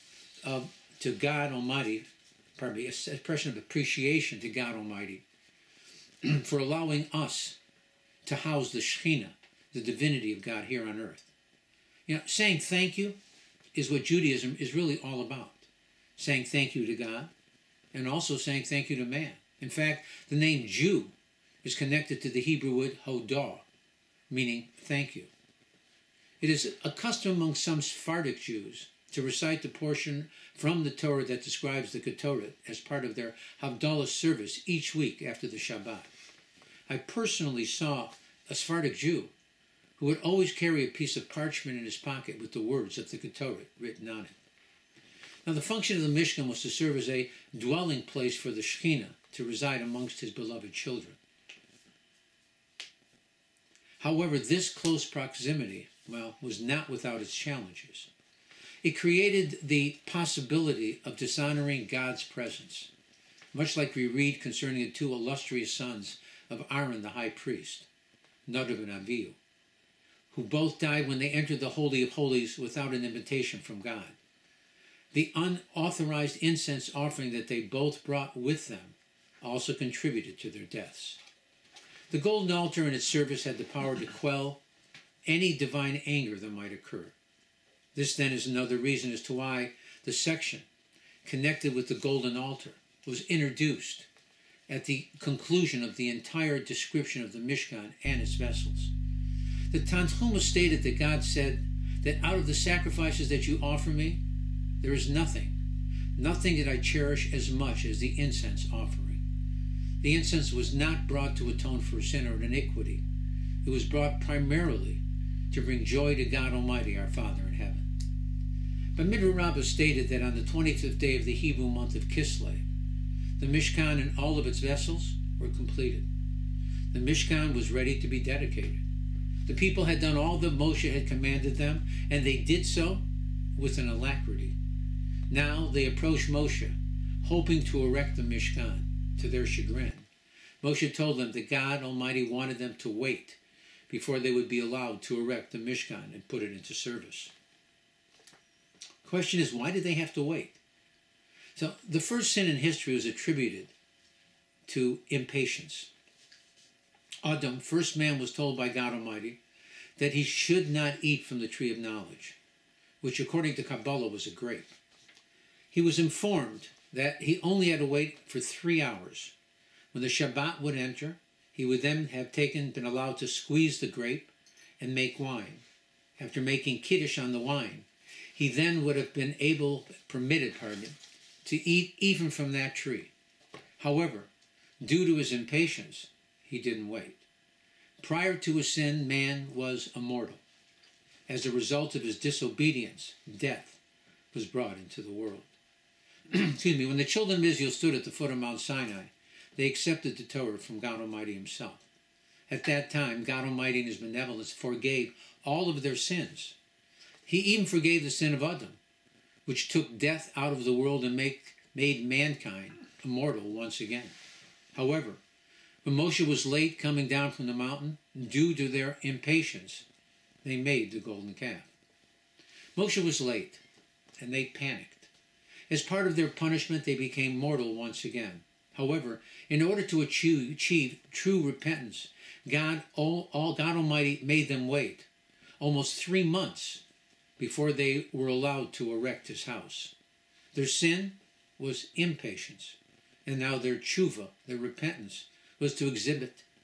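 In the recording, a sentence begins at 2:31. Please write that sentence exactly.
So the first sin in history was attributed to impatience.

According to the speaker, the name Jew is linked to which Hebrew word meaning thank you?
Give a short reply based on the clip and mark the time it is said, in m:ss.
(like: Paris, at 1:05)
hodah, at 0:23.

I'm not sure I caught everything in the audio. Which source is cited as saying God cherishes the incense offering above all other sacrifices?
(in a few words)
Tanhuma.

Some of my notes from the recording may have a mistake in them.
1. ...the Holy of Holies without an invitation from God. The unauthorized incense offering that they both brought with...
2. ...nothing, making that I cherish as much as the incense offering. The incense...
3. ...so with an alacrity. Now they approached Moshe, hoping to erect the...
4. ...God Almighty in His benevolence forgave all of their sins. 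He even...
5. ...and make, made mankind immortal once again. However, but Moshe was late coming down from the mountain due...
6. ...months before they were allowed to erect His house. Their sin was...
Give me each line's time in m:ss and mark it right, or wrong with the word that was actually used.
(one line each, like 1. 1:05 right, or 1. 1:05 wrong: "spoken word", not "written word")
1. 1:11 right
2. 1:45 wrong: "nothing", not "making"
3. 2:12 right
4. 3:23 right
5. 3:31 right
6. 3:56 right.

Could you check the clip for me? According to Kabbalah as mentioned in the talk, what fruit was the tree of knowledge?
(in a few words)
a grape.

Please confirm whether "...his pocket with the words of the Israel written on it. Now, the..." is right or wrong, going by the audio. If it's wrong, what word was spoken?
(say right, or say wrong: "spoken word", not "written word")
wrong: "Ketoret", not "Israel".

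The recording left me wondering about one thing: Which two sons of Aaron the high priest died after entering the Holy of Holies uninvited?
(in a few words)
Nadab and Avihu.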